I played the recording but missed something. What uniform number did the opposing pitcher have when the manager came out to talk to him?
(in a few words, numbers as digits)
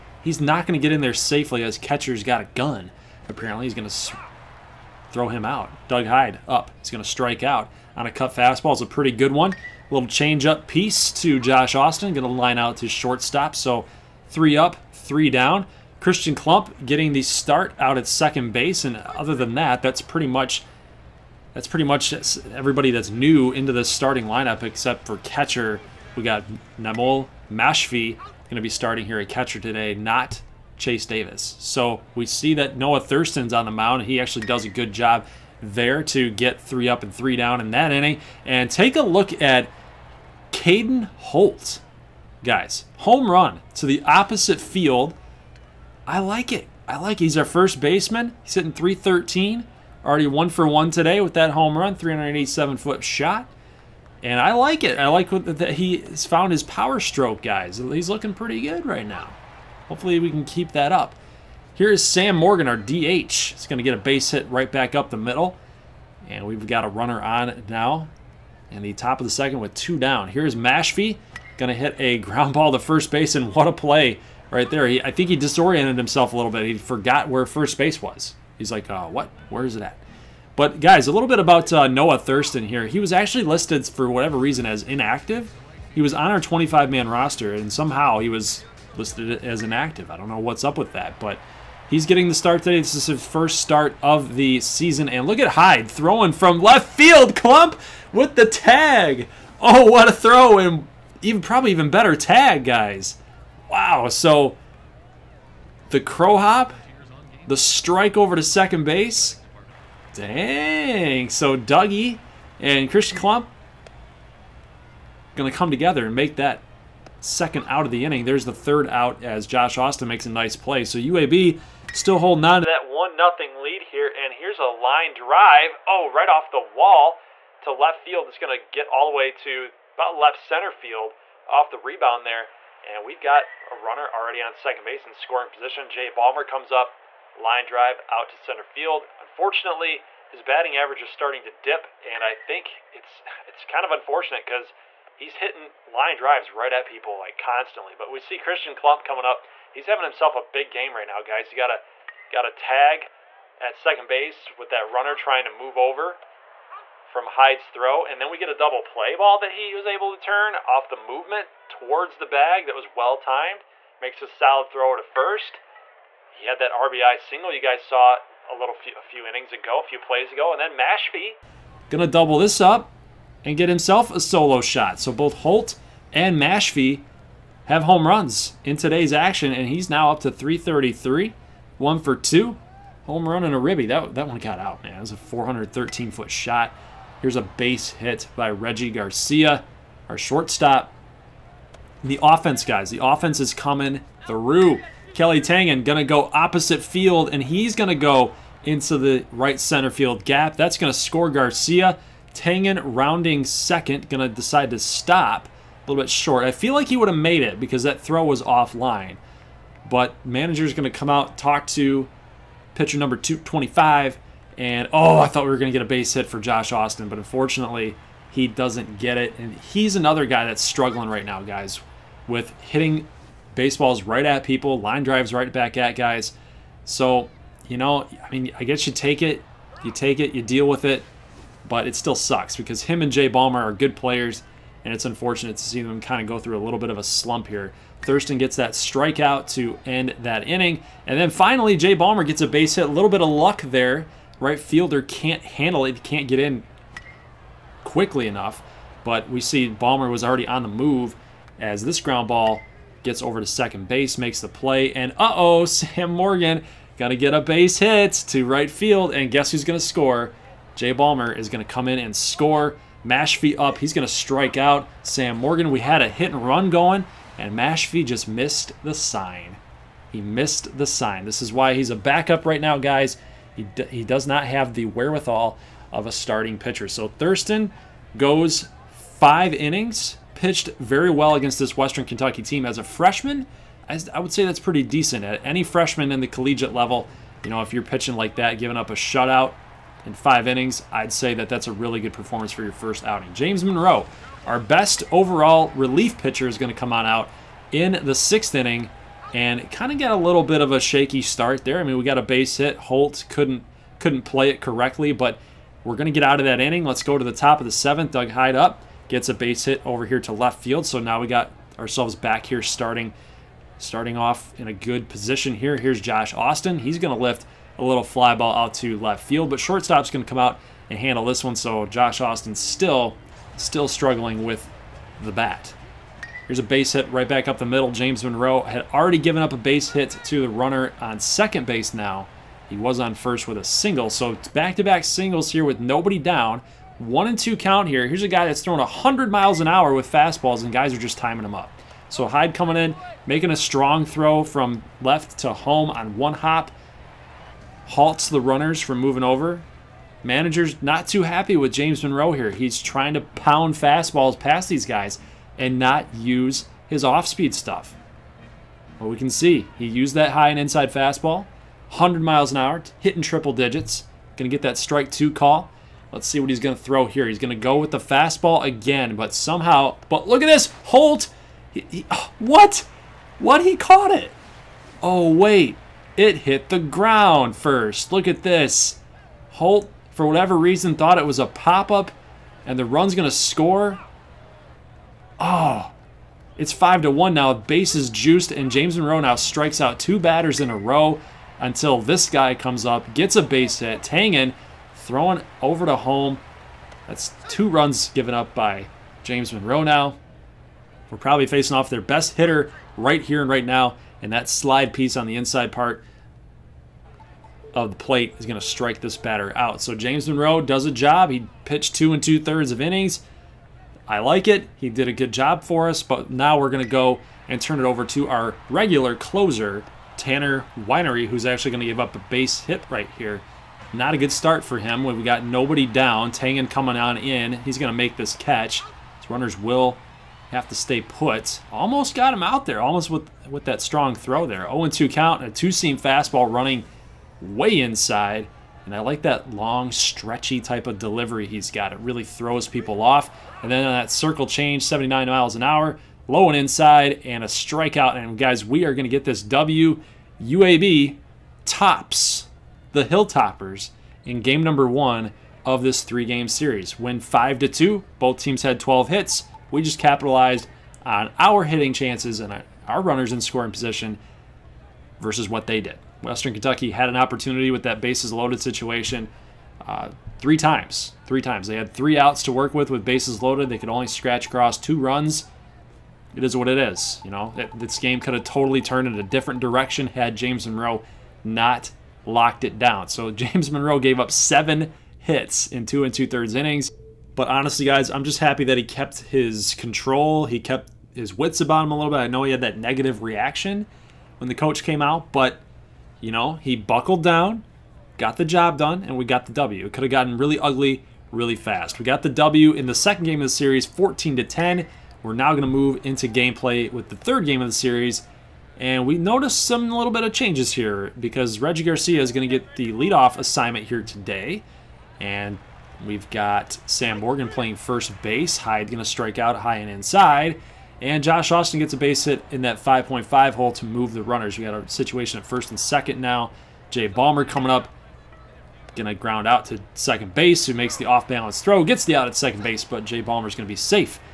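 225.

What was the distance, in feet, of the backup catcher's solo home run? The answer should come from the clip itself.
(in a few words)
413.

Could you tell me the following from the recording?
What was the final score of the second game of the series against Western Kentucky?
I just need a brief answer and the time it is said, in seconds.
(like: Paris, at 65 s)
14 to 10, at 503 s.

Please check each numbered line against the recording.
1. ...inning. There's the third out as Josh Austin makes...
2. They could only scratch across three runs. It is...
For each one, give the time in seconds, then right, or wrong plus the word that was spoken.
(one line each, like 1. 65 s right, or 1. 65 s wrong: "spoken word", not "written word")
1. 118 s right
2. 473 s wrong: "two", not "three".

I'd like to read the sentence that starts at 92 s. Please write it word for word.
This is his first start of the season, and look at Hyde throwing from left field.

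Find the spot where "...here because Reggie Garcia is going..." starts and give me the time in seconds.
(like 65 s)
510 s.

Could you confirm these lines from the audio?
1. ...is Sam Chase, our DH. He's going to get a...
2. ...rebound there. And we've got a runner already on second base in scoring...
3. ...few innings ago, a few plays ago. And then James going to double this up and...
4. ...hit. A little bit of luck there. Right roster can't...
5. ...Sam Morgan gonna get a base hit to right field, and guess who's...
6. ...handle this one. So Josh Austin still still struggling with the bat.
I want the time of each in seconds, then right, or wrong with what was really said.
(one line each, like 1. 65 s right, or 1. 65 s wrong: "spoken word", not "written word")
1. 61 s wrong: "Morgan", not "Chase"
2. 131 s right
3. 169 s wrong: "Mashfee", not "James"
4. 242 s wrong: "fielder", not "roster"
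5. 255 s right
6. 320 s right.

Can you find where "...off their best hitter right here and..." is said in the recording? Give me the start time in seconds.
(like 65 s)
401 s.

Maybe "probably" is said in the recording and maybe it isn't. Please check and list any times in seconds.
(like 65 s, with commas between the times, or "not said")
101 s, 401 s.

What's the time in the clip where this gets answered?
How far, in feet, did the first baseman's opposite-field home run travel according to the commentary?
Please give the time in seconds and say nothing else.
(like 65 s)
51 s.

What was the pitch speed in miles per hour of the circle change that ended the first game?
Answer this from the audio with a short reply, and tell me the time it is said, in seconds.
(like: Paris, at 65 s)
79, at 444 s.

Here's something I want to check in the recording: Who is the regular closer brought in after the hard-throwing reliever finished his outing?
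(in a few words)
Tanner Winery.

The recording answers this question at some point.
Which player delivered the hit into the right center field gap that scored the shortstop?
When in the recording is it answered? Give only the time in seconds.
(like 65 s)
195 s.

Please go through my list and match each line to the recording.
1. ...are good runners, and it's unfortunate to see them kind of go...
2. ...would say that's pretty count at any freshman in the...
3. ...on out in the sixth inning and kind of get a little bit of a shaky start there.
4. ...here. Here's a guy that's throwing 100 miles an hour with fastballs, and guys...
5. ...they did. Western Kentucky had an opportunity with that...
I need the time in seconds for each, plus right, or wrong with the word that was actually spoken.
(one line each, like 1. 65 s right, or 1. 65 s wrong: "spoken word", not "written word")
1. 233 s wrong: "players", not "runners"
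2. 284 s wrong: "decent", not "count"
3. 296 s right
4. 337 s right
5. 465 s right.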